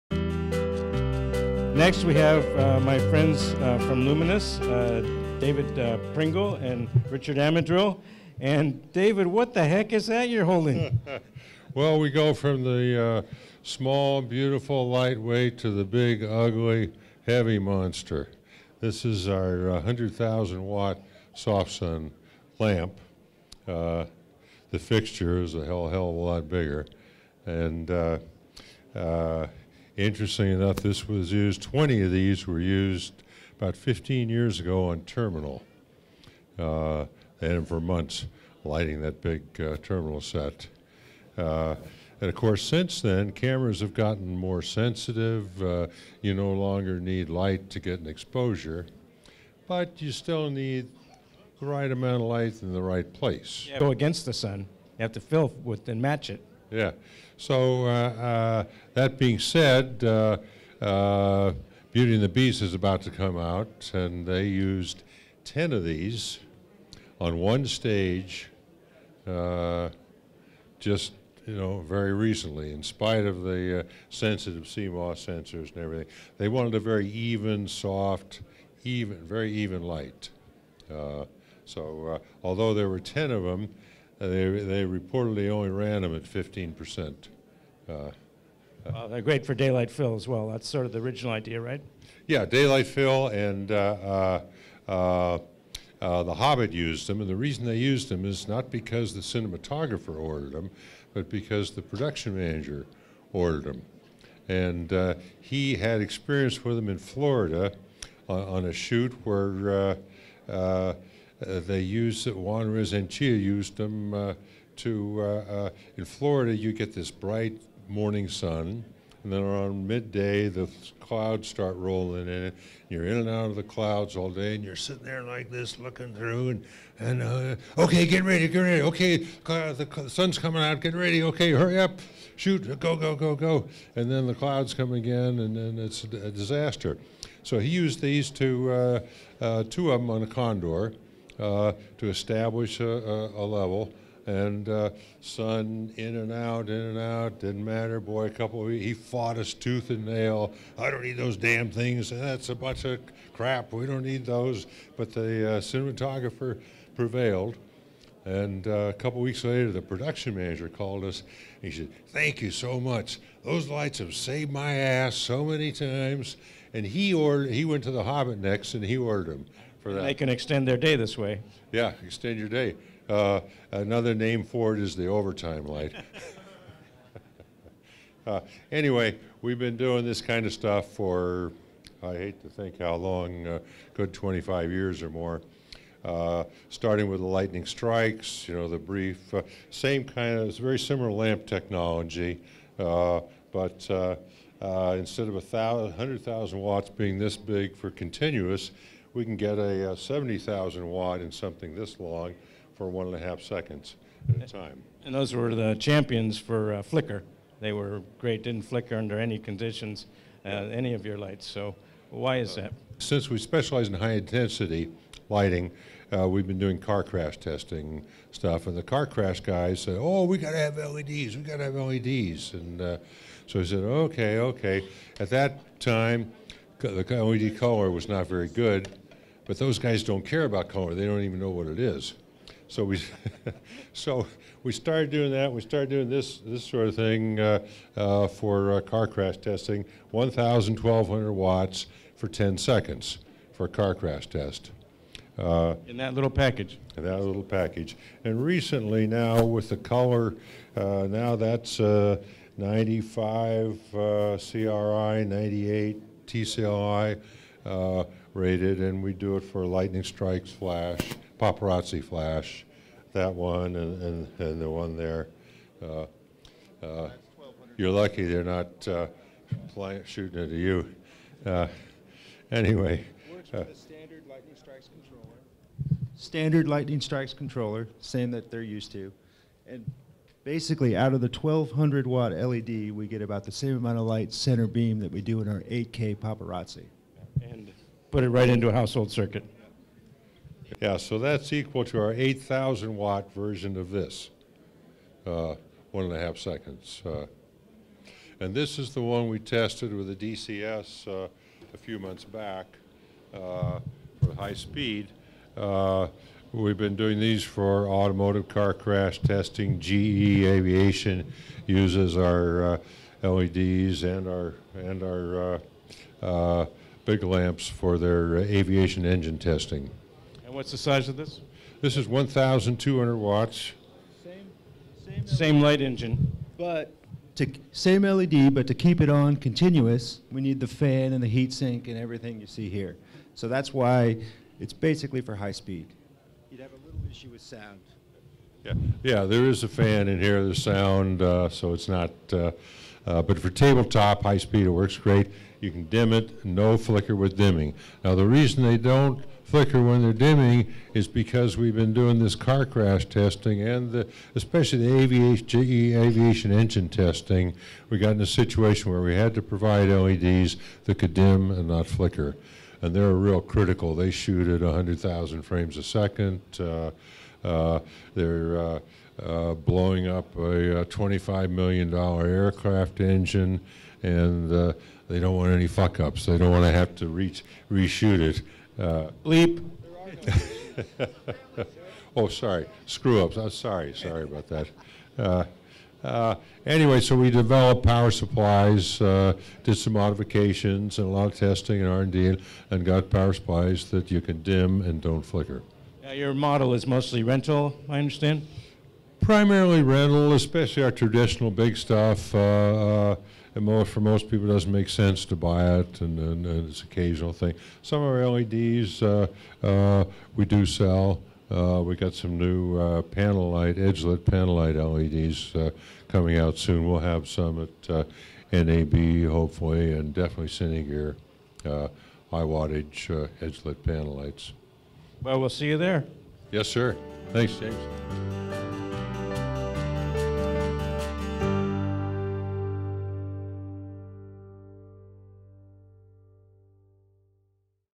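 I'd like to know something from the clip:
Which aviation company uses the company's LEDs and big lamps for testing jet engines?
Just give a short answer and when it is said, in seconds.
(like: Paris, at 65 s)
GE Aviation, at 309 s.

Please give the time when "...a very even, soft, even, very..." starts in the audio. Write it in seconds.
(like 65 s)
76 s.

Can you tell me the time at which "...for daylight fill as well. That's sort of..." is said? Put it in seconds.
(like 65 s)
89 s.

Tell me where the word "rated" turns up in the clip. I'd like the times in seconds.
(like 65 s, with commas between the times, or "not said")
258 s.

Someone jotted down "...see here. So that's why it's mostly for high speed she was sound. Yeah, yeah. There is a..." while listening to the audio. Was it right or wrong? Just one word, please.
wrong.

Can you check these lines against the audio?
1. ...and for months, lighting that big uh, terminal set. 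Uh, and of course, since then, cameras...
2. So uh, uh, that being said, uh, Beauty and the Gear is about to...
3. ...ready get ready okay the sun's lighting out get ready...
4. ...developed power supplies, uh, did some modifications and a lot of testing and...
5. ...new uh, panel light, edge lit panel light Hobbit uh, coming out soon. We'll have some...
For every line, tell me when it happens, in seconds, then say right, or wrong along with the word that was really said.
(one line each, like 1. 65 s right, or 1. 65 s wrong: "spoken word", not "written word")
1. 37 s right
2. 57 s wrong: "Beast", not "Gear"
3. 128 s wrong: "coming", not "lighting"
4. 387 s right
5. 412 s wrong: "LEDs", not "Hobbit".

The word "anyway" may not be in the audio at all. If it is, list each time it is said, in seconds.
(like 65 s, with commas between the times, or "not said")
178 s, 272 s, 386 s.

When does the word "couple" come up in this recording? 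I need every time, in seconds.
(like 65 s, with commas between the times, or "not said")
148 s, 158 s.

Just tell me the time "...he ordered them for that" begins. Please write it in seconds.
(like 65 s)
168 s.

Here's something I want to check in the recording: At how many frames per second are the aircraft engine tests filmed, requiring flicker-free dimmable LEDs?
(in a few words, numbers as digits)
100,000.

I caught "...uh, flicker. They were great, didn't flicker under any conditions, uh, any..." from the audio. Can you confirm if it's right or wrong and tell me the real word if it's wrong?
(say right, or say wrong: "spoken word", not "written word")
right.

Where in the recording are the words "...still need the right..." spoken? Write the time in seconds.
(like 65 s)
50 s.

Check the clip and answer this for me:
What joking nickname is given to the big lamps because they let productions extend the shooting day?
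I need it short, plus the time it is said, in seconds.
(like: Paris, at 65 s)
the overtime light, at 174 s.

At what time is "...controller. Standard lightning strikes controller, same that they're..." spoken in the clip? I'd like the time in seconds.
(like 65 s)
274 s.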